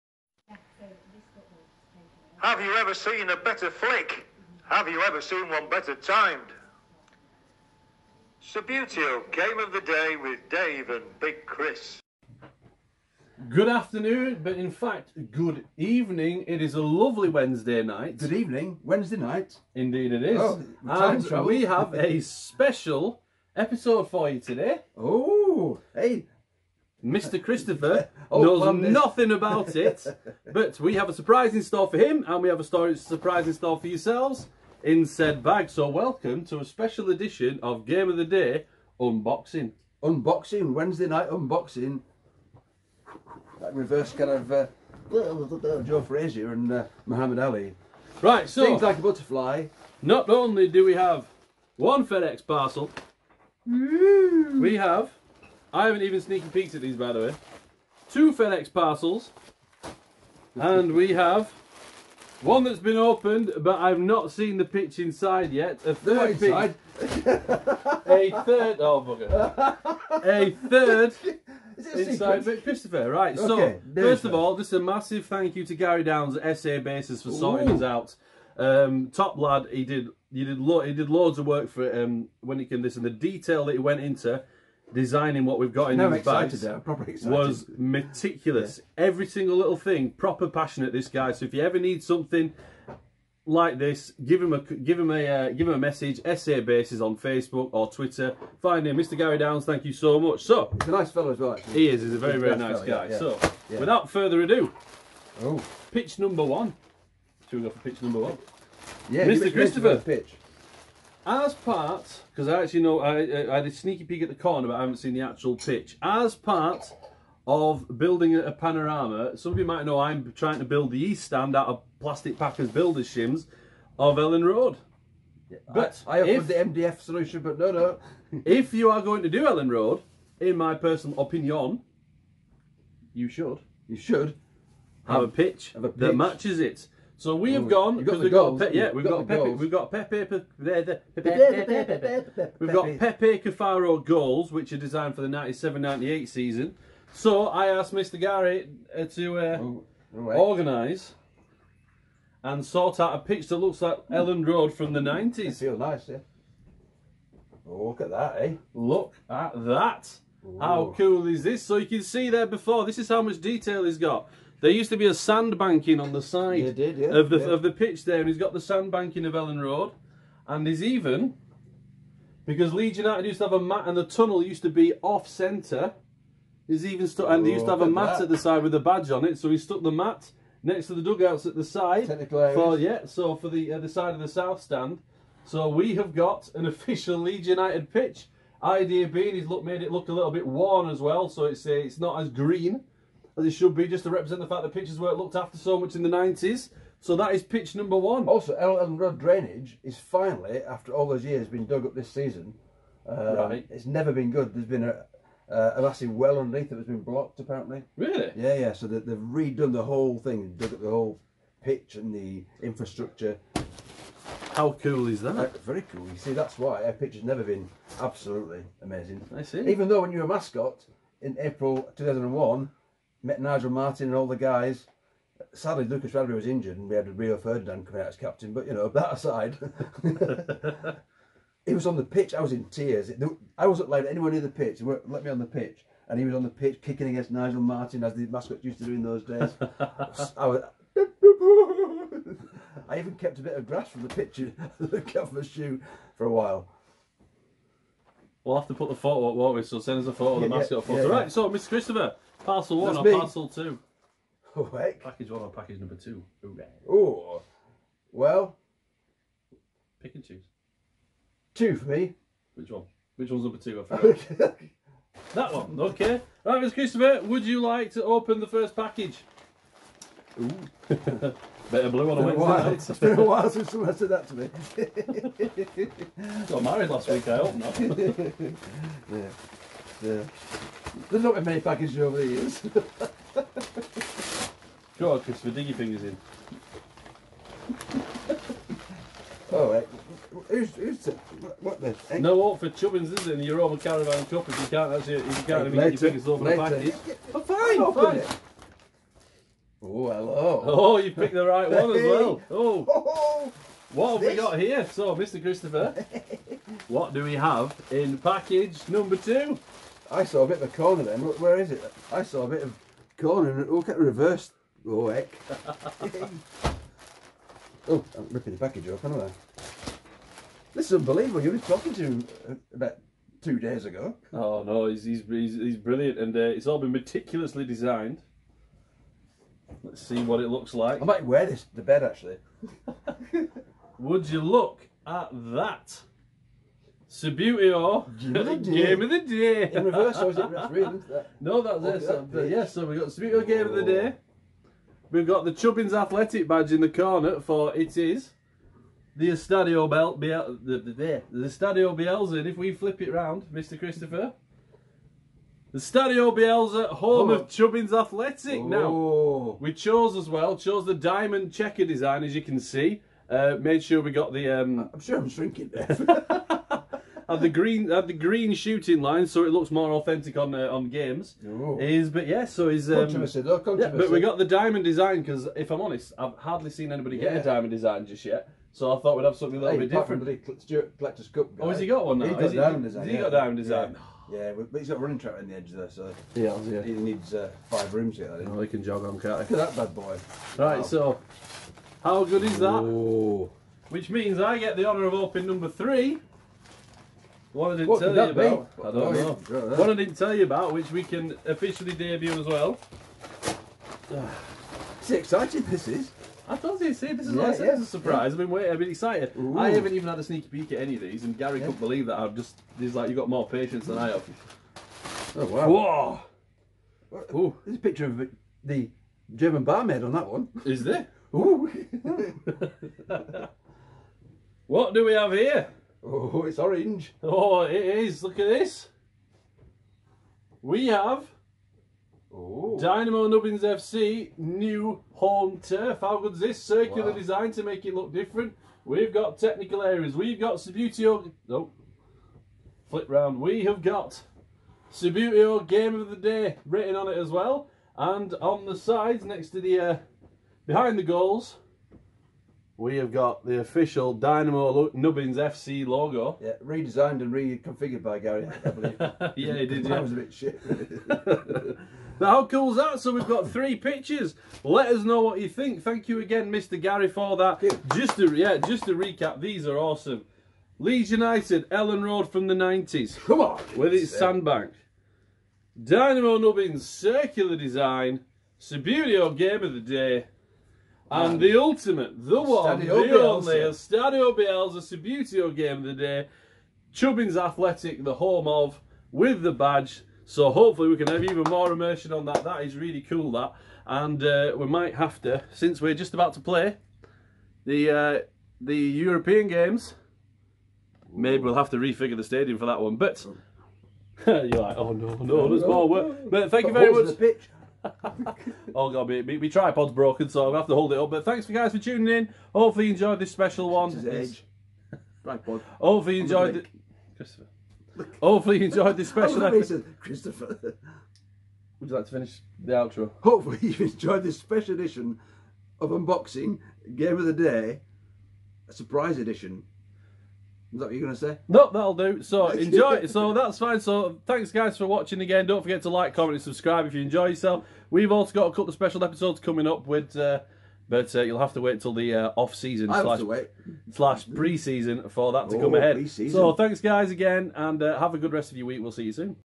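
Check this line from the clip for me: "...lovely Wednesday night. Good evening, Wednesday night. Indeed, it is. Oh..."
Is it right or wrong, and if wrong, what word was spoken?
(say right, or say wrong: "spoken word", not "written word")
right.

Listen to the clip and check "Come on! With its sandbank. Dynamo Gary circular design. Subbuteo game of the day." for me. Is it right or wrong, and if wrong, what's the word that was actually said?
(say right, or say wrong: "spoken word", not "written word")
wrong: "Nubbins", not "Gary".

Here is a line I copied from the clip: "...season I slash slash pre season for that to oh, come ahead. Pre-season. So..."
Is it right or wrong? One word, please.
right.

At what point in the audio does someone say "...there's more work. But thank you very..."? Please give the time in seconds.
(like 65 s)
505 s.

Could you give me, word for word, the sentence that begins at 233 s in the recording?
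I wasn't allowed anywhere near the pitch.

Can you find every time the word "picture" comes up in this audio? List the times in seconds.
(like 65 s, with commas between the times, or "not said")
244 s, 417 s, 463 s.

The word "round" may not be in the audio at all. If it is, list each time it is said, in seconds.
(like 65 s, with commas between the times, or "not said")
353 s, 443 s.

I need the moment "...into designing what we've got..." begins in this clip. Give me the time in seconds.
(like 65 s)
84 s.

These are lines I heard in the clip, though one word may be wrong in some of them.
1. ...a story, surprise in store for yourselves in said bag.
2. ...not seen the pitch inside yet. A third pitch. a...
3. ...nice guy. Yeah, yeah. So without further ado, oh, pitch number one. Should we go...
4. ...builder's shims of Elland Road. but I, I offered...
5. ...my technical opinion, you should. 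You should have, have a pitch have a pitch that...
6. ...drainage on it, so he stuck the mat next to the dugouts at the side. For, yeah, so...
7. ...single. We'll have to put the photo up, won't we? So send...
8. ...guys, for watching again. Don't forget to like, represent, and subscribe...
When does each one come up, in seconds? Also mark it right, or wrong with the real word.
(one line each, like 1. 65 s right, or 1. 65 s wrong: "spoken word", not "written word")
1. 32 s right
2. 64 s right
3. 102 s right
4. 122 s right
5. 130 s wrong: "personal", not "technical"
6. 178 s wrong: "badge", not "drainage"
7. 246 s wrong: "while", not "single"
8. 534 s wrong: "comment", not "represent".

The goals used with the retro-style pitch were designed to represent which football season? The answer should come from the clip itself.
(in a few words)
1997-98.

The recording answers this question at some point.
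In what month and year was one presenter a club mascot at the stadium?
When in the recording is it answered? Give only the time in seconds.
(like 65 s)
221 s.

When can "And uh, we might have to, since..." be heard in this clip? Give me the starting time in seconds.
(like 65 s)
493 s.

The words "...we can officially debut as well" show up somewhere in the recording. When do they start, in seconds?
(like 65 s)
400 s.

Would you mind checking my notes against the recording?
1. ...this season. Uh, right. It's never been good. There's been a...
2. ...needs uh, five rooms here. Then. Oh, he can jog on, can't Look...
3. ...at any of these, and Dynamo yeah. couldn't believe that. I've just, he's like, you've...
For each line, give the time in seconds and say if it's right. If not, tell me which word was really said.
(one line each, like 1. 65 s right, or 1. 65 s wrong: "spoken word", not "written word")
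1. 201 s right
2. 386 s right
3. 410 s wrong: "Gary", not "Dynamo".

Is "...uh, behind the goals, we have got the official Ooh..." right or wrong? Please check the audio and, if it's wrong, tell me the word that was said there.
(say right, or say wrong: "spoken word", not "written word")
wrong: "Dynamo", not "Ooh".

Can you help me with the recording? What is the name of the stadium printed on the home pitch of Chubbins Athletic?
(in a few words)
Estadio Bielsa.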